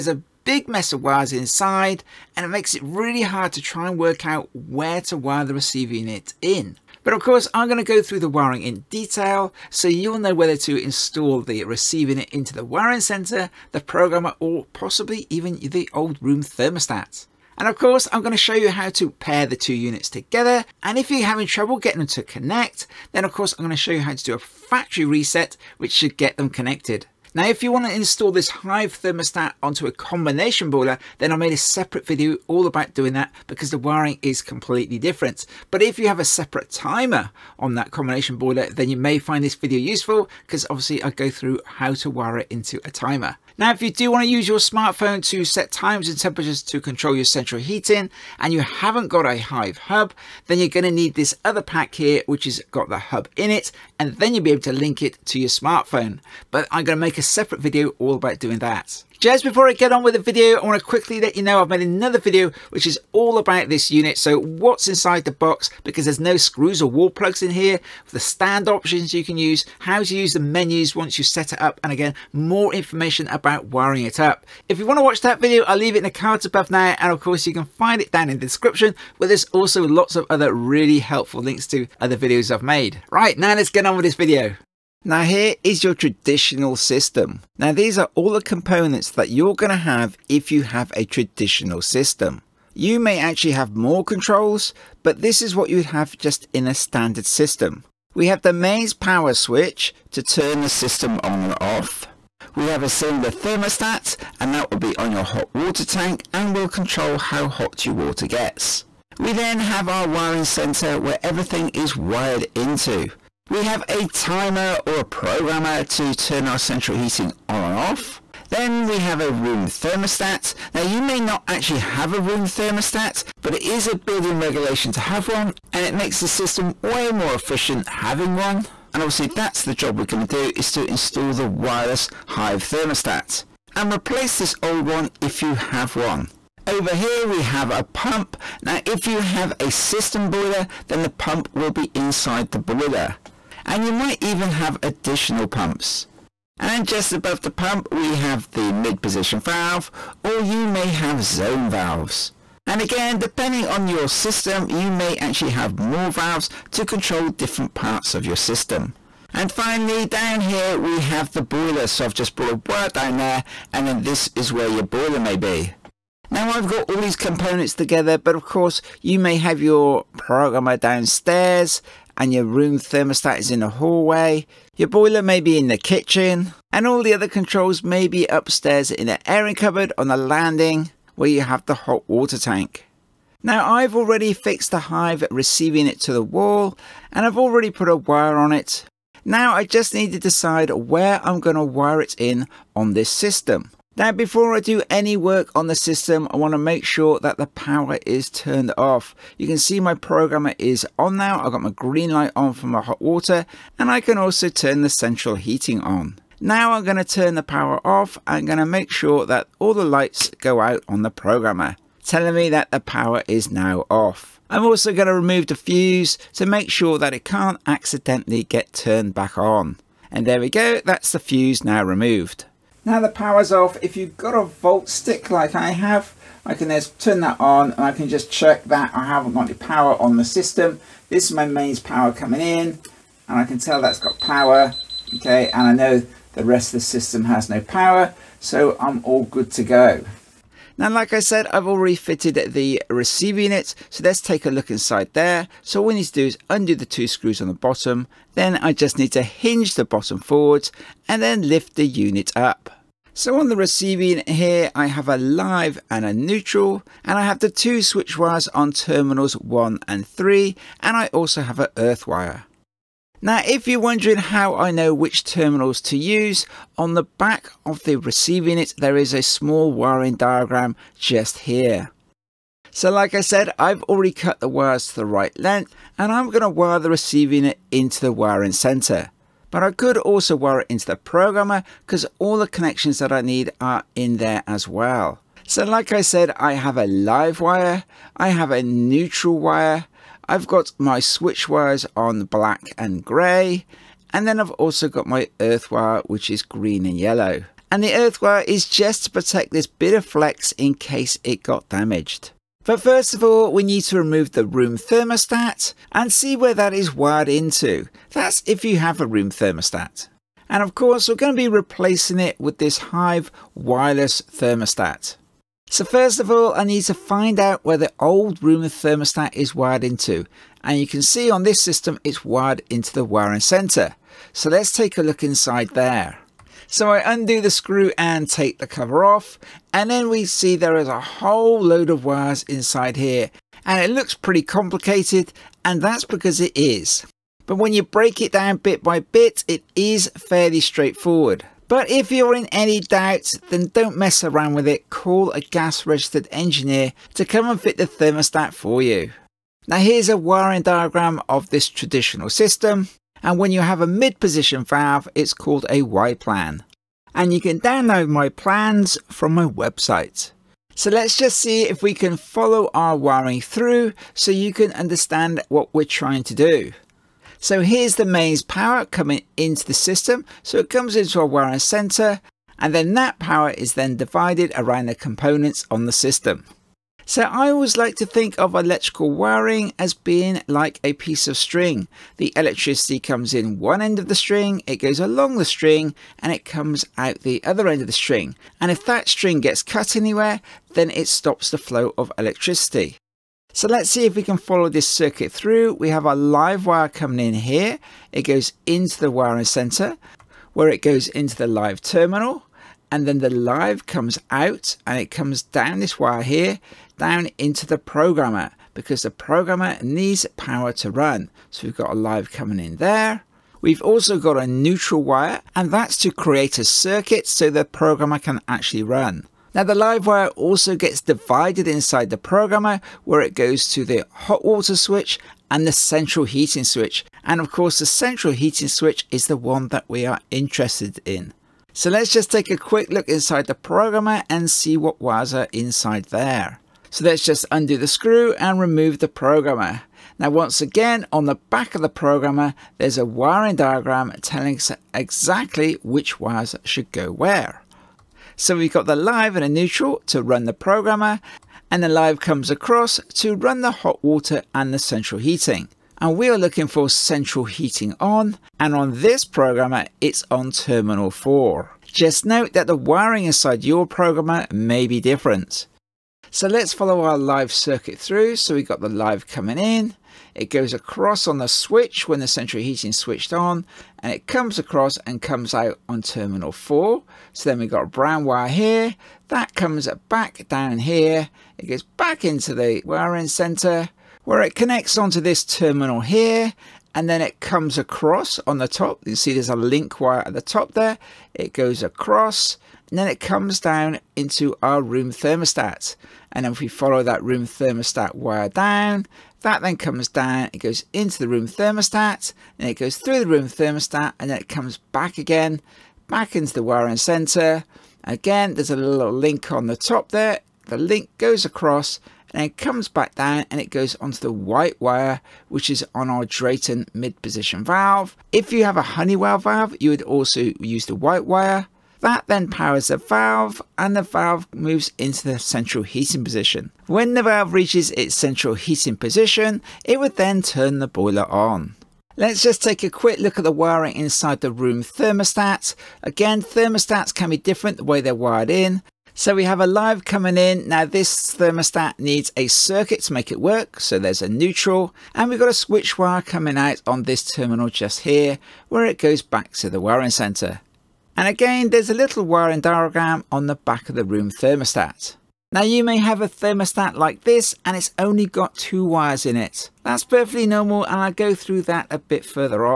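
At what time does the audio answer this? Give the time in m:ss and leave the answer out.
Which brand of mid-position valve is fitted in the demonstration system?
8:36.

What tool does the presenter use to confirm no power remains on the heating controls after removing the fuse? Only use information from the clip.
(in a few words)
Volt stick.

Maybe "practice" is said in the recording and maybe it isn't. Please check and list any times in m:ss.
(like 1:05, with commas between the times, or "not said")
not said.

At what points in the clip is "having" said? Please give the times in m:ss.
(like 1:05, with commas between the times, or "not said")
0:21, 2:07.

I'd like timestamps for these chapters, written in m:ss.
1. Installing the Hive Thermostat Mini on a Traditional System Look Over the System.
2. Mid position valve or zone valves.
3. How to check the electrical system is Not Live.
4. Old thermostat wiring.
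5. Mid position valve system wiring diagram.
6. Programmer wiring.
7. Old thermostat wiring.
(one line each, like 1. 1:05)
1. 1:27
2. 2:25
3. 3:42
4. 5:19
5. 5:48
6. 7:19
7. 8:50.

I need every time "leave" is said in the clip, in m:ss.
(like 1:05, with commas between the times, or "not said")
1:15.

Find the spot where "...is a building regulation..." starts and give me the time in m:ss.
2:03.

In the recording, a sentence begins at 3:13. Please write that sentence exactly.
Now before I do any work on the system, I want to make sure that the power is turned off.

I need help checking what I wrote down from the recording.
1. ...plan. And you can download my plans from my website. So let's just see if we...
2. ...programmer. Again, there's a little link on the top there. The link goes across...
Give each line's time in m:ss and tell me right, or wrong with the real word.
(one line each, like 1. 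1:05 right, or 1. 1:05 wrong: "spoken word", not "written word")
1. 5:56 right
2. 8:26 wrong: "center", not "programmer".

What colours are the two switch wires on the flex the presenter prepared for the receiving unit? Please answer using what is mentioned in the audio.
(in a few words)
Black and grey.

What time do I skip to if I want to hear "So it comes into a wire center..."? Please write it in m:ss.
6:10.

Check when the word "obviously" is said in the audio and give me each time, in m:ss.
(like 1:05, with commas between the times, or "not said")
0:40, 2:09.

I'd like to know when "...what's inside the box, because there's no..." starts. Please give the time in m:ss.
1:04.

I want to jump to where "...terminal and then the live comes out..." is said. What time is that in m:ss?
6:41.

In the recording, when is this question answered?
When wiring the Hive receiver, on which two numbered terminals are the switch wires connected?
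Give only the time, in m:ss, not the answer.
4:18.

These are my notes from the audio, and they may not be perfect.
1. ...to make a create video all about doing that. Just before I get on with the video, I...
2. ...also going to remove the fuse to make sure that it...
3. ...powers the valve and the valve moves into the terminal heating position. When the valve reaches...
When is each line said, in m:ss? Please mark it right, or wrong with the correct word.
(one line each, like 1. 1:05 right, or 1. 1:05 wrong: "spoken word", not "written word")
1. 0:56 wrong: "separate", not "create"
2. 3:34 right
3. 8:42 wrong: "central", not "terminal".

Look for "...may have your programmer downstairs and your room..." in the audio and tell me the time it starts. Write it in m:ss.
2:49.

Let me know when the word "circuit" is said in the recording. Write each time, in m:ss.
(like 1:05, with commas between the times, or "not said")
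6:34, 6:56, 7:47, 9:02.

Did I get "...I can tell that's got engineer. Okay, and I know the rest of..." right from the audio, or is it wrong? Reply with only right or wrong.
wrong.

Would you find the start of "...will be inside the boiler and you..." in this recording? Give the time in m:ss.
2:21.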